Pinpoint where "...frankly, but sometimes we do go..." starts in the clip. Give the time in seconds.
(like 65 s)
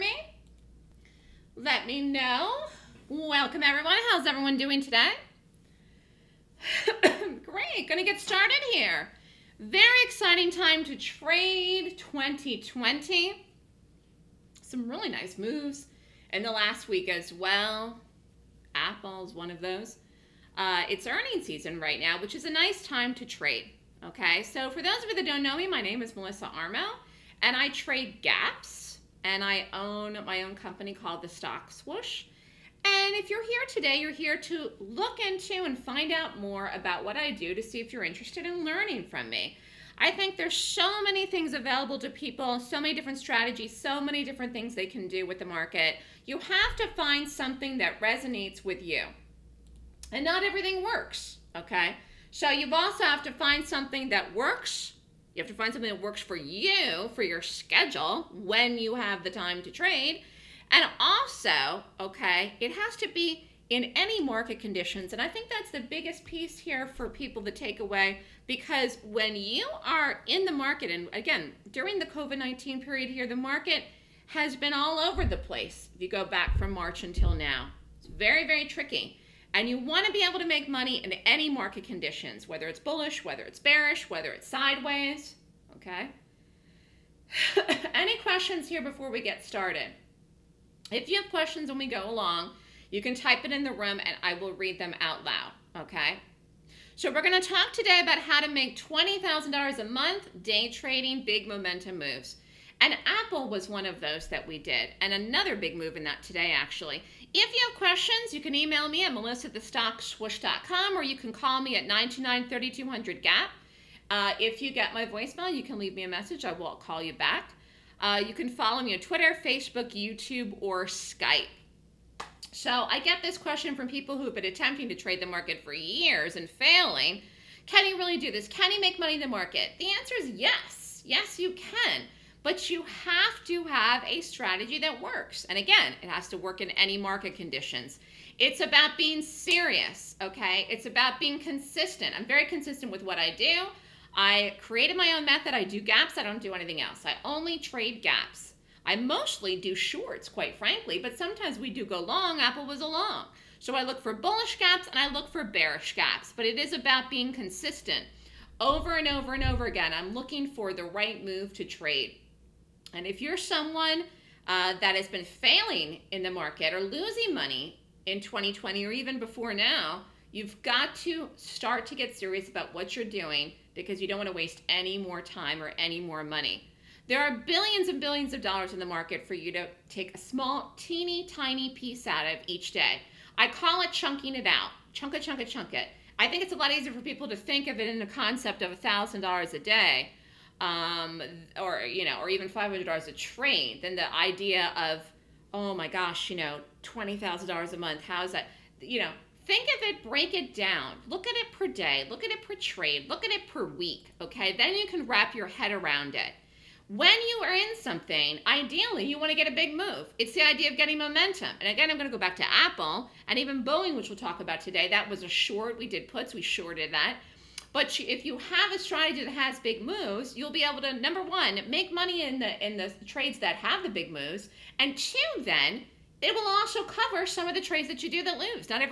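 150 s.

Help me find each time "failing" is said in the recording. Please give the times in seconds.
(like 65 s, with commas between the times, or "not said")
126 s, 165 s.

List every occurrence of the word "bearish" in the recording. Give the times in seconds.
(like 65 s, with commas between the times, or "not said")
83 s, 155 s.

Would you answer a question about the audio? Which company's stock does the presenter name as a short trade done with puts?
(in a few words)
Boeing.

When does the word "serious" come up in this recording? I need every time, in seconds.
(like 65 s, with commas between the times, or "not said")
139 s, 172 s.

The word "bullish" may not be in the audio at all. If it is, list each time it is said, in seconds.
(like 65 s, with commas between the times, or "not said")
82 s, 154 s.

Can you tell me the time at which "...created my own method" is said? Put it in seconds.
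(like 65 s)
144 s.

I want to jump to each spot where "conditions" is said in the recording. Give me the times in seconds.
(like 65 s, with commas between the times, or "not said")
64 s, 81 s, 137 s.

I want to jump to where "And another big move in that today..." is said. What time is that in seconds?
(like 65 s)
104 s.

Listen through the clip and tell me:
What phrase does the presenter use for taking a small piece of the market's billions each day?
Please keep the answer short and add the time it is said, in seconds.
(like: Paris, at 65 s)
Chunking it out, at 183 s.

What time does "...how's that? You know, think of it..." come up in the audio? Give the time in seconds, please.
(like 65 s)
198 s.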